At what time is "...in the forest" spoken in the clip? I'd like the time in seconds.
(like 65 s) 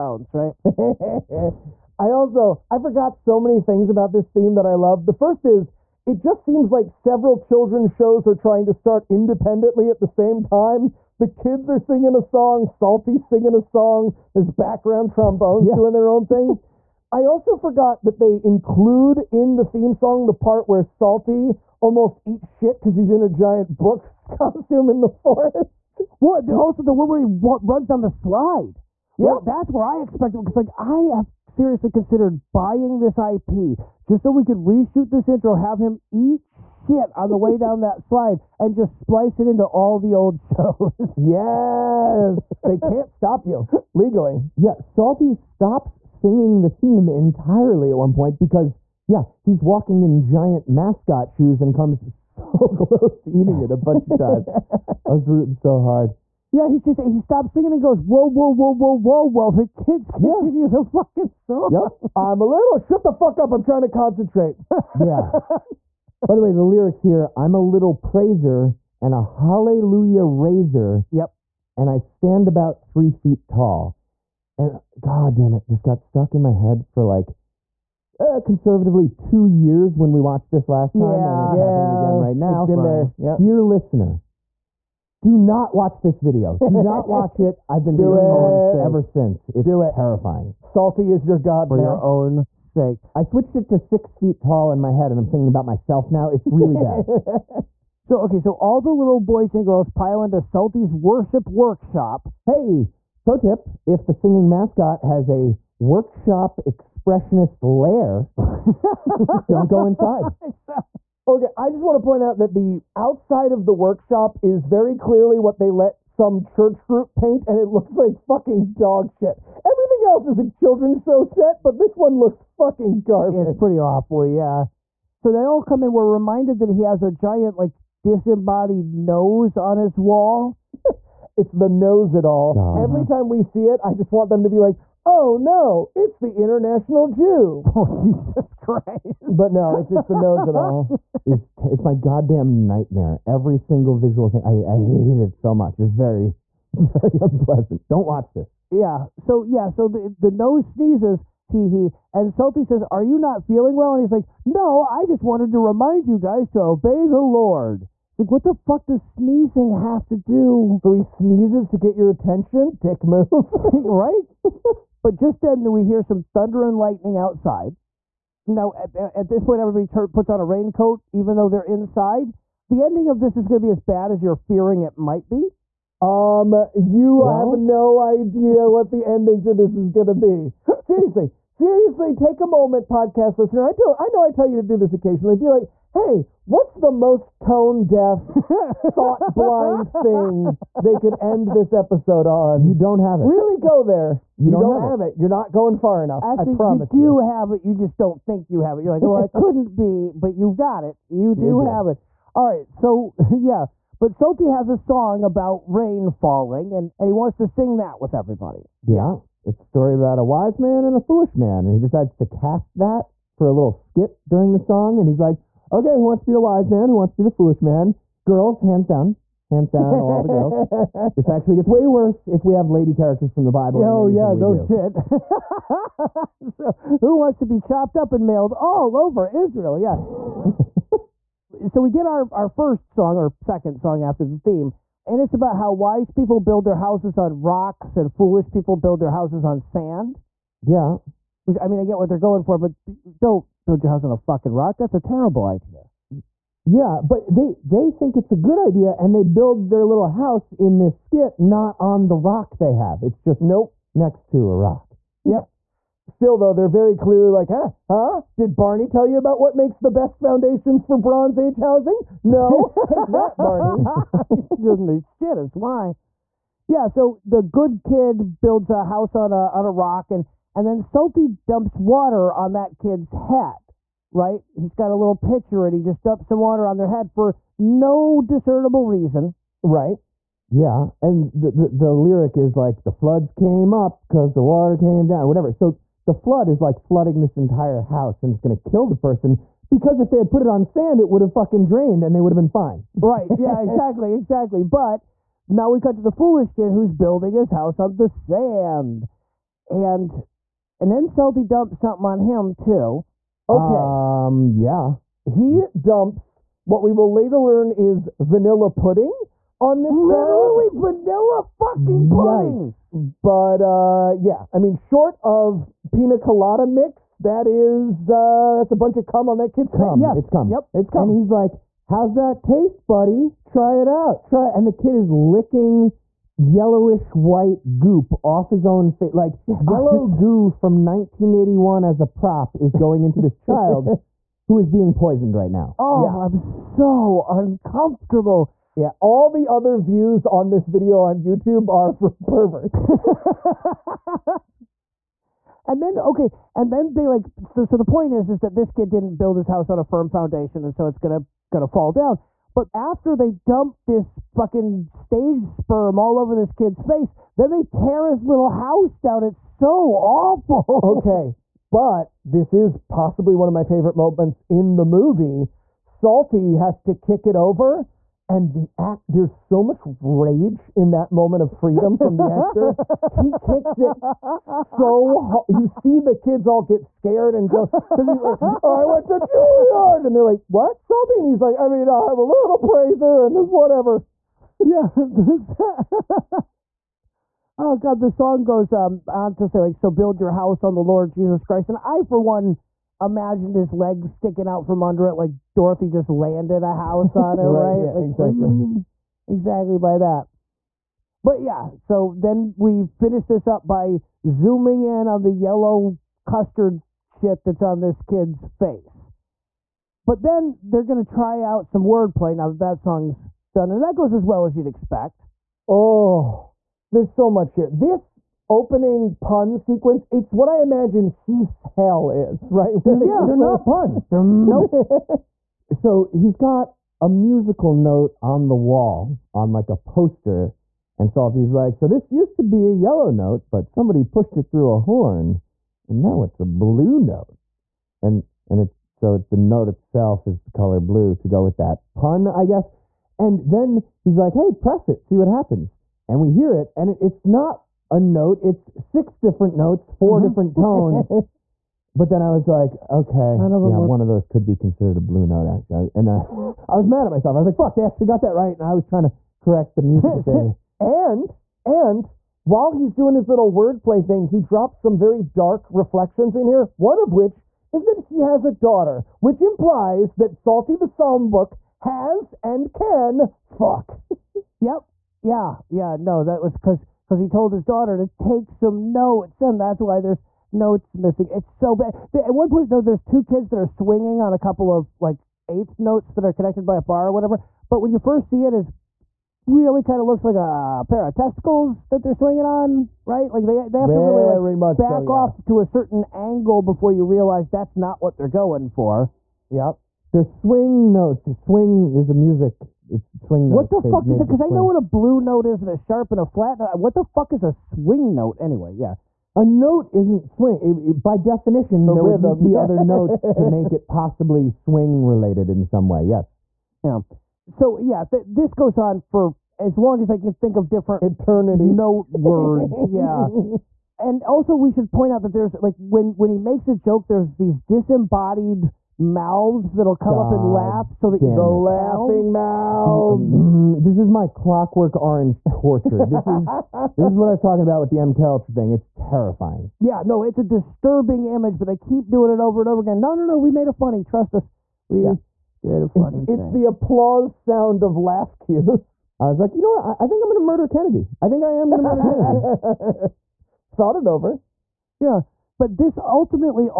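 24 s.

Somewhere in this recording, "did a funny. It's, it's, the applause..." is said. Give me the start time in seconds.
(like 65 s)
545 s.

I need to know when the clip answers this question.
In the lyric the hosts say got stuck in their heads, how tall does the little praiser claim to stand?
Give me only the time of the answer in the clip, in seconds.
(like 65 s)
72 s.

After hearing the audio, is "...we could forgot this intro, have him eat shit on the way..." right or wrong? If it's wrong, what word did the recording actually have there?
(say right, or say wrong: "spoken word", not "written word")
wrong: "reshoot", not "forgot".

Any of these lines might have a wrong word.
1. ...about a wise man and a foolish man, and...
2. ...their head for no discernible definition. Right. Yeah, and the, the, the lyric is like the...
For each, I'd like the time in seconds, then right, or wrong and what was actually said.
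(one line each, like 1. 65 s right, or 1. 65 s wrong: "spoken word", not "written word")
1. 209 s right
2. 276 s wrong: "reason", not "definition".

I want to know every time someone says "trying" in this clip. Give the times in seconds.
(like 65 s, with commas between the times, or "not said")
8 s, 63 s, 458 s.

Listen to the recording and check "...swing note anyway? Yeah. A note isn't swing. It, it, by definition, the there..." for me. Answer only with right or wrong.
right.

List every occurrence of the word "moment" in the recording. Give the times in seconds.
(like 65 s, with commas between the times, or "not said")
182 s, 363 s, 371 s.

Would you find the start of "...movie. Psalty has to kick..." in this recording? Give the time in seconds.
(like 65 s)
364 s.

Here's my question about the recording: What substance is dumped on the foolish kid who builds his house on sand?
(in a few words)
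vanilla pudding.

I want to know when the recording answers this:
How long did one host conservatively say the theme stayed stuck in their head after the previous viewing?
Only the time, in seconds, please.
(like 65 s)
79 s.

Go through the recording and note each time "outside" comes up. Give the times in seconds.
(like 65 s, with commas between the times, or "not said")
112 s, 167 s.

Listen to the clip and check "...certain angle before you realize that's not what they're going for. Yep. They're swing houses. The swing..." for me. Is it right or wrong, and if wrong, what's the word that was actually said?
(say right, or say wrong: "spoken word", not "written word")
wrong: "notes", not "houses".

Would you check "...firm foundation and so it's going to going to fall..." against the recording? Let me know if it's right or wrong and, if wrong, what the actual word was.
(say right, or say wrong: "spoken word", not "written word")
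right.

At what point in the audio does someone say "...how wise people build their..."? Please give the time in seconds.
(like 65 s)
235 s.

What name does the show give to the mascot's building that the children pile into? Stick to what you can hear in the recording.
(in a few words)
Psalty's worship workshop.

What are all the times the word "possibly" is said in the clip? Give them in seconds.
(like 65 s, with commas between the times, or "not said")
362 s, 513 s.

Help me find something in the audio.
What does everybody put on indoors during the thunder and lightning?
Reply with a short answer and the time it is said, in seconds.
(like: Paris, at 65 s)
a raincoat, at 170 s.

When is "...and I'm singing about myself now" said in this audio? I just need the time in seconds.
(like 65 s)
95 s.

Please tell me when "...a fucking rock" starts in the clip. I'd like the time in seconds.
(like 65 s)
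244 s.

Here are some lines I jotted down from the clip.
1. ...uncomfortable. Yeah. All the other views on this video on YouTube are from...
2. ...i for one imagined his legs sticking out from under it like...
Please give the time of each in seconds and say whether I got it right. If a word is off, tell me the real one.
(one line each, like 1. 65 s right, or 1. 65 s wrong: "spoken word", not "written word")
1. 337 s right
2. 391 s right.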